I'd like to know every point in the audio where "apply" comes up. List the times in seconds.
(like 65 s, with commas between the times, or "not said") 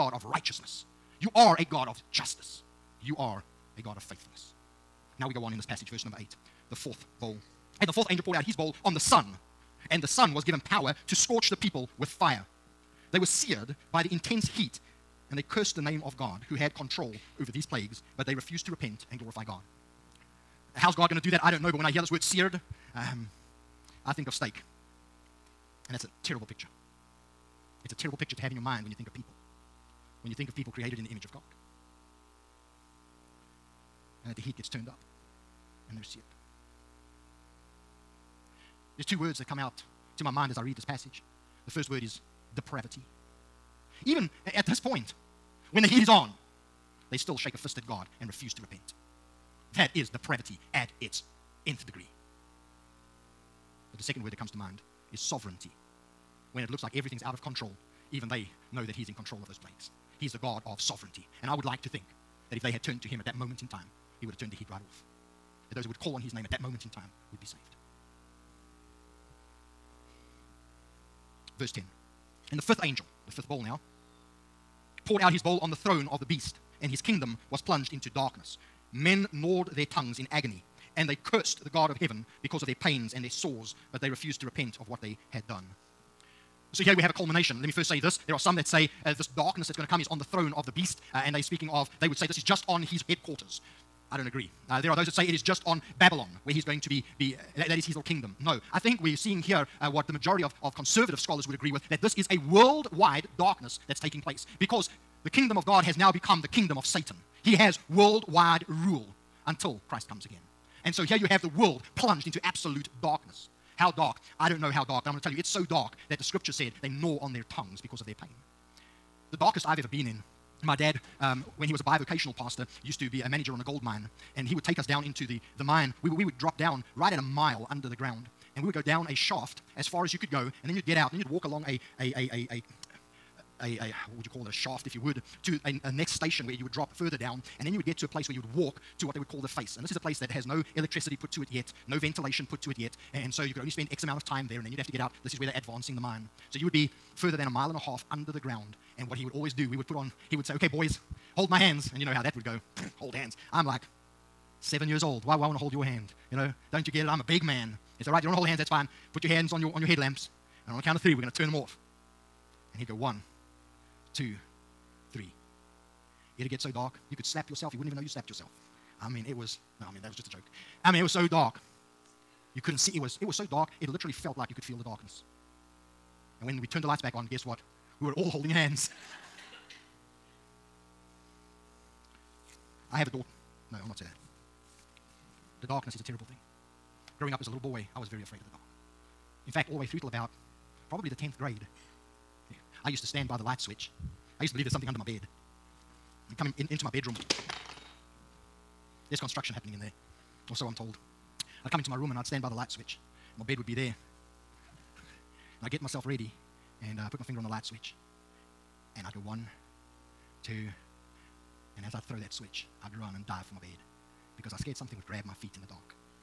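not said.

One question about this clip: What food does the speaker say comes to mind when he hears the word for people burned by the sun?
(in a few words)
Steak.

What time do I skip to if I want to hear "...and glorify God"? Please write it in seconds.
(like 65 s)
19 s.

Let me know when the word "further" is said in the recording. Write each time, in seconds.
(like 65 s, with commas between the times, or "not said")
136 s, 147 s.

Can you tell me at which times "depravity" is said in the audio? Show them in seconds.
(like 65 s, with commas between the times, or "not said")
42 s, 50 s.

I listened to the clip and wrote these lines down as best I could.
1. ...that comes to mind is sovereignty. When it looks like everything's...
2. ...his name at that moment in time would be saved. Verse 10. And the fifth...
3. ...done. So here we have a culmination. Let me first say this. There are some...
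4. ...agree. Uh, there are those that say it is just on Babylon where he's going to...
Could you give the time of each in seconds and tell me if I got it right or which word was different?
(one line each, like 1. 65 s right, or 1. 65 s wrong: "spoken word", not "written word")
1. 54 s right
2. 66 s right
3. 85 s right
4. 94 s right.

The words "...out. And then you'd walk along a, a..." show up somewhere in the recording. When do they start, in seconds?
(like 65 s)
130 s.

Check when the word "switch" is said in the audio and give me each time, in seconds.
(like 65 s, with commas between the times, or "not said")
193 s, 202 s, 207 s, 212 s.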